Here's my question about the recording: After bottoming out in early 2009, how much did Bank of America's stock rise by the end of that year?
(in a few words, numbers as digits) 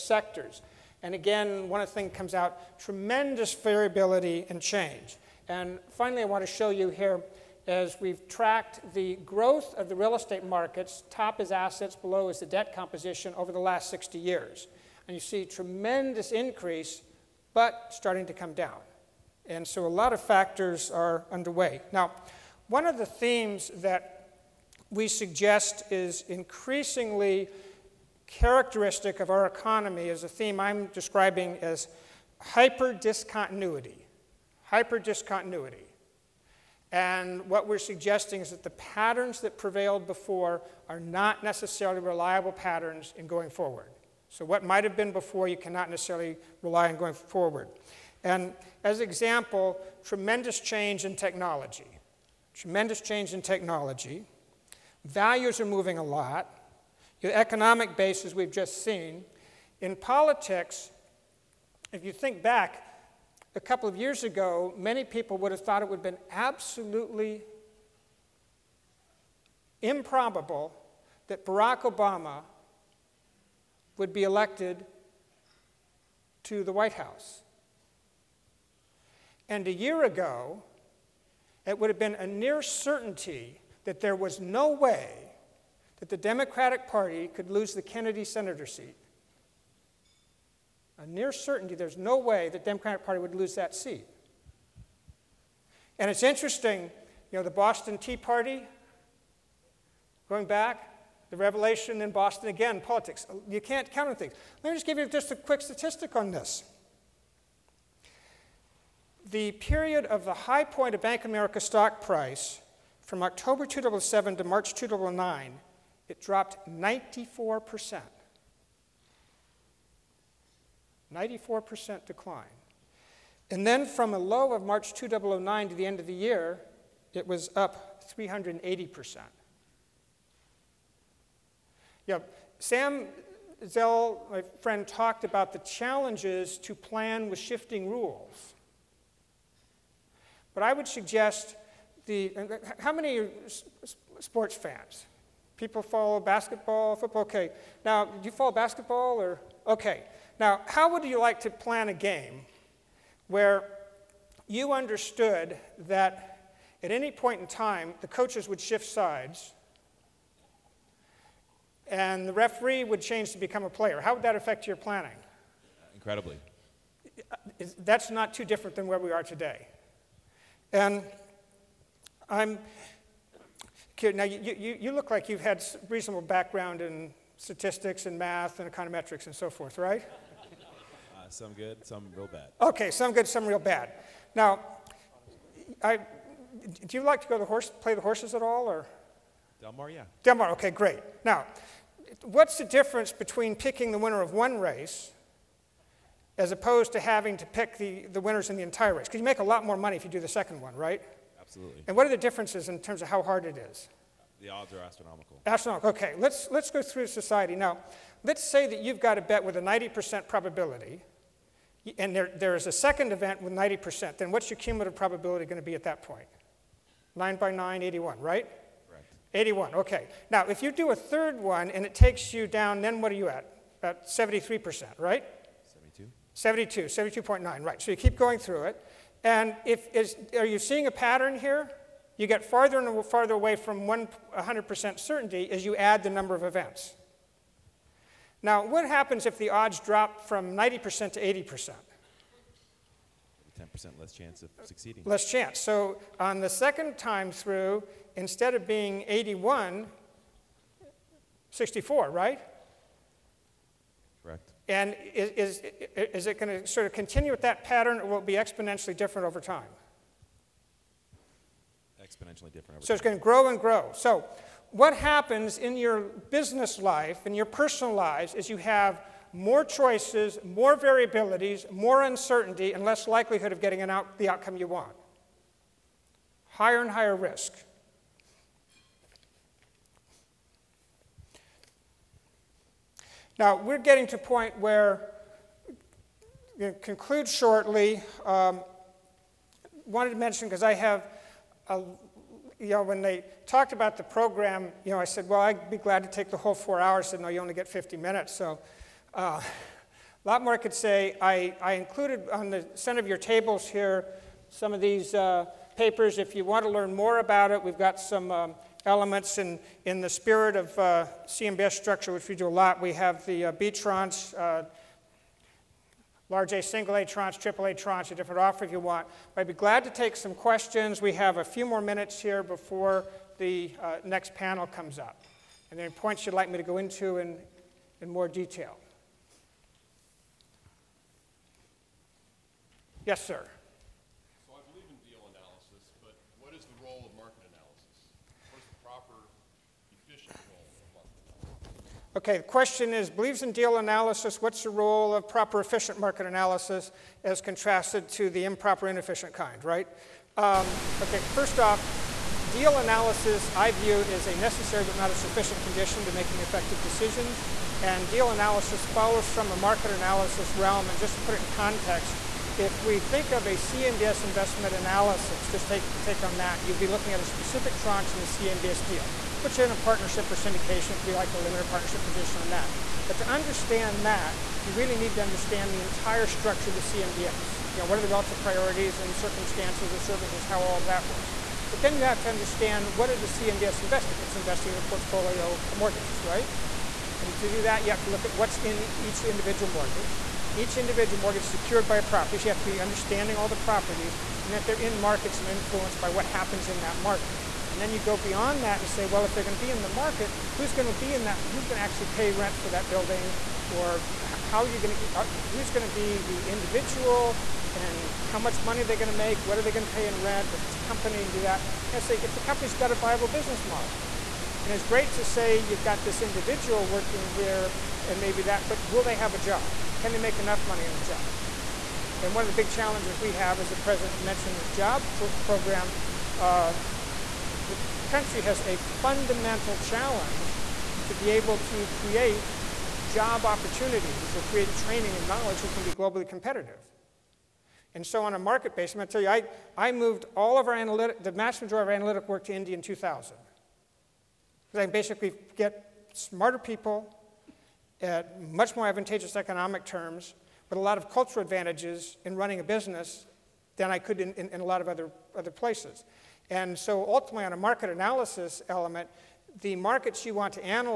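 380%.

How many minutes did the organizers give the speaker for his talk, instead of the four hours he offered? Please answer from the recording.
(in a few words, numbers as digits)
50 minutes.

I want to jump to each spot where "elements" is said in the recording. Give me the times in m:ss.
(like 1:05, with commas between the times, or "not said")
5:08, 7:38.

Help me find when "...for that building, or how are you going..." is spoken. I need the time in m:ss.
6:42.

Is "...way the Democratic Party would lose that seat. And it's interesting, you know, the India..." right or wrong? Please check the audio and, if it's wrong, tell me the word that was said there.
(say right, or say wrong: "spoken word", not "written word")
wrong: "Boston", not "India".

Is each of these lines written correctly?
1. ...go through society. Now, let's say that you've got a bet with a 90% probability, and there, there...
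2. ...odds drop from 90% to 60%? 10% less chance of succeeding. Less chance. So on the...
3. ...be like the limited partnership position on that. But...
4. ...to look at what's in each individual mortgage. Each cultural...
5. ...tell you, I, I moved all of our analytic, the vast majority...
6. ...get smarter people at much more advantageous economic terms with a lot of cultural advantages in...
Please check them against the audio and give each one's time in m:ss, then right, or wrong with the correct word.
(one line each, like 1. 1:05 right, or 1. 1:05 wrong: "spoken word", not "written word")
1. 3:26 right
2. 3:59 wrong: "80", not "60"
3. 6:11 right
4. 6:28 wrong: "individual", not "cultural"
5. 7:19 right
6. 7:25 right.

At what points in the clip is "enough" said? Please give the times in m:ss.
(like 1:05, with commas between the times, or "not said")
7:00.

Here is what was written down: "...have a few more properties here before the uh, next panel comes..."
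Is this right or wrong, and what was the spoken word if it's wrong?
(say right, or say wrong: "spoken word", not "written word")
wrong: "minutes", not "properties".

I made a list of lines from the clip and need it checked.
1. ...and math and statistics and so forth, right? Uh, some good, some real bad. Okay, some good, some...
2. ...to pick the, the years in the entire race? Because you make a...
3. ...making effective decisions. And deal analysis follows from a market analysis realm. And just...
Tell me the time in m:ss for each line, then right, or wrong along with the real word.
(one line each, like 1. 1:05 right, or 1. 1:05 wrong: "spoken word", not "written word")
1. 2:58 wrong: "econometrics", not "statistics"
2. 3:17 wrong: "winners", not "years"
3. 5:56 right.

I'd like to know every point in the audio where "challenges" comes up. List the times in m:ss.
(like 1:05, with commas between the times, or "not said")
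2:15, 7:02, 7:09.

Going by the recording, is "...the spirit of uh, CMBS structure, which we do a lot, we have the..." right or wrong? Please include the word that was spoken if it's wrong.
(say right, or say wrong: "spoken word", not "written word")
right.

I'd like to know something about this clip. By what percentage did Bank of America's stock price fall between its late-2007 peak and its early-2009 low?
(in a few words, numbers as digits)
94%.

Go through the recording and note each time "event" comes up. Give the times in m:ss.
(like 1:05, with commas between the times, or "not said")
3:33, 3:56.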